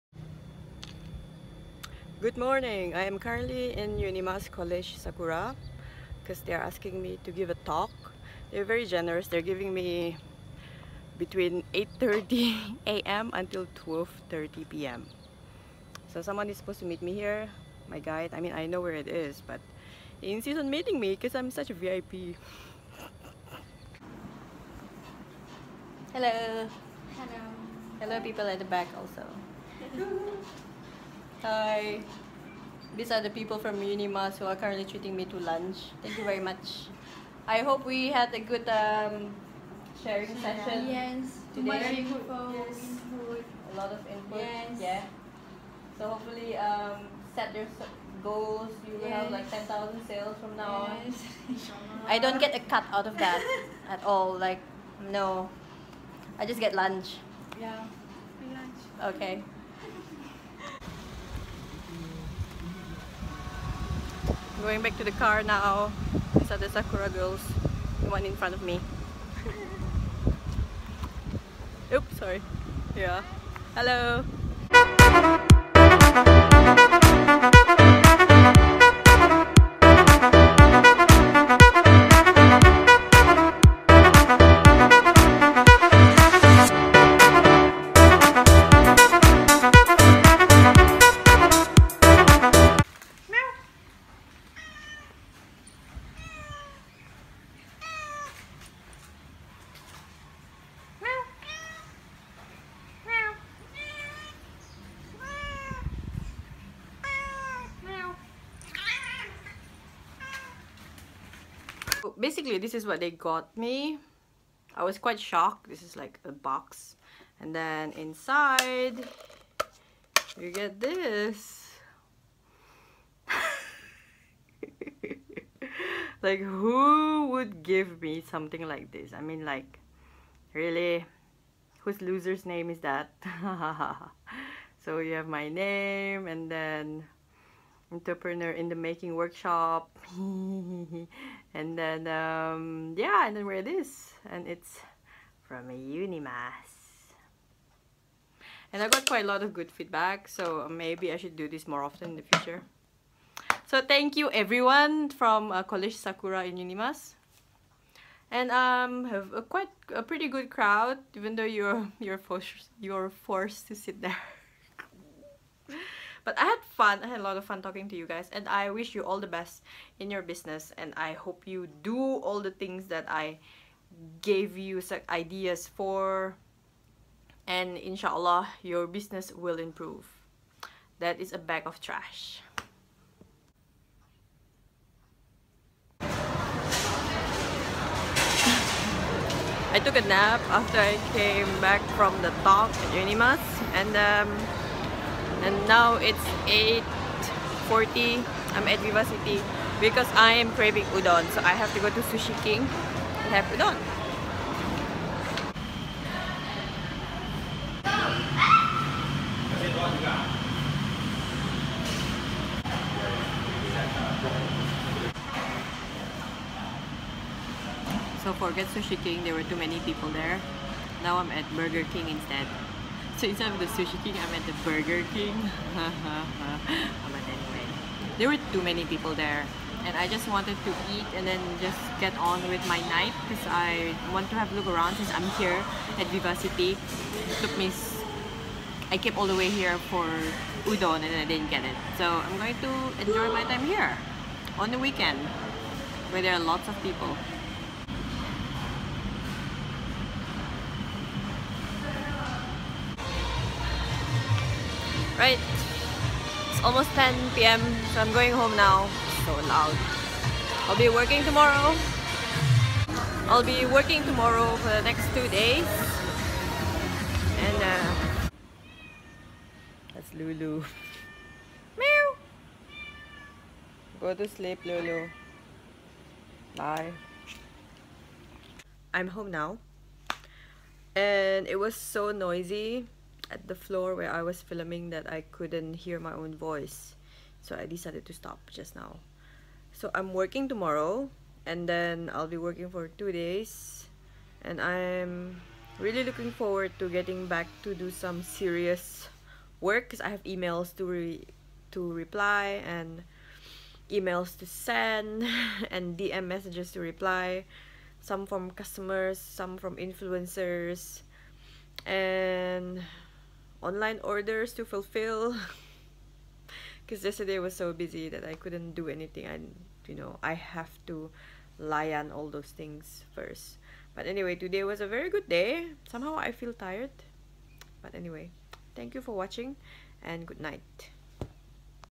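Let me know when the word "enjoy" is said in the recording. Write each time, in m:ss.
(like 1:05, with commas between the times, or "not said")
4:03.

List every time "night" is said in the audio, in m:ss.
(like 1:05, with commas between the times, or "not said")
3:52, 5:30.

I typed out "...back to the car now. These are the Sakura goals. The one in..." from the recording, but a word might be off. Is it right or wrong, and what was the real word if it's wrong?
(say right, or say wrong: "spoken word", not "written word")
wrong: "girls", not "goals".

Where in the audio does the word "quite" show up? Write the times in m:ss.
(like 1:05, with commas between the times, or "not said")
1:54, 2:29, 2:39.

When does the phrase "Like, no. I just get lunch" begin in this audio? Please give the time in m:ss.
0:54.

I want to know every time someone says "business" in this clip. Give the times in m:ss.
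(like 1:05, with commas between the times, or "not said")
2:50, 2:58.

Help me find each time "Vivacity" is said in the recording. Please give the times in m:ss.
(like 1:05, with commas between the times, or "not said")
3:18, 3:56.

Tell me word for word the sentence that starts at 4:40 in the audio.
And it was so noisy at the floor where I was filming that I couldn't hear my own voice.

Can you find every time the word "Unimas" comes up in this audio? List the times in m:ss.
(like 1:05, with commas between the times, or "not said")
0:03, 0:33, 2:25, 2:36, 3:12.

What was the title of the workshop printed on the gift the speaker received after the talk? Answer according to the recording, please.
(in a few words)
Entrepreneur in the making.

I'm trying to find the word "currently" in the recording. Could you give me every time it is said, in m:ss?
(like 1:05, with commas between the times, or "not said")
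0:03, 0:34.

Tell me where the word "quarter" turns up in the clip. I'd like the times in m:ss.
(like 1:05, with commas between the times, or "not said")
not said.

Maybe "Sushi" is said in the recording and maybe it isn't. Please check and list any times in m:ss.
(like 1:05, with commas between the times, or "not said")
3:22, 3:38, 3:43.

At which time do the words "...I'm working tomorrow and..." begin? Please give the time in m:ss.
4:49.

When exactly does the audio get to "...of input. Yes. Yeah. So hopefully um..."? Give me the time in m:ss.
0:43.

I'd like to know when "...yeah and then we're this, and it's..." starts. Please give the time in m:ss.
2:22.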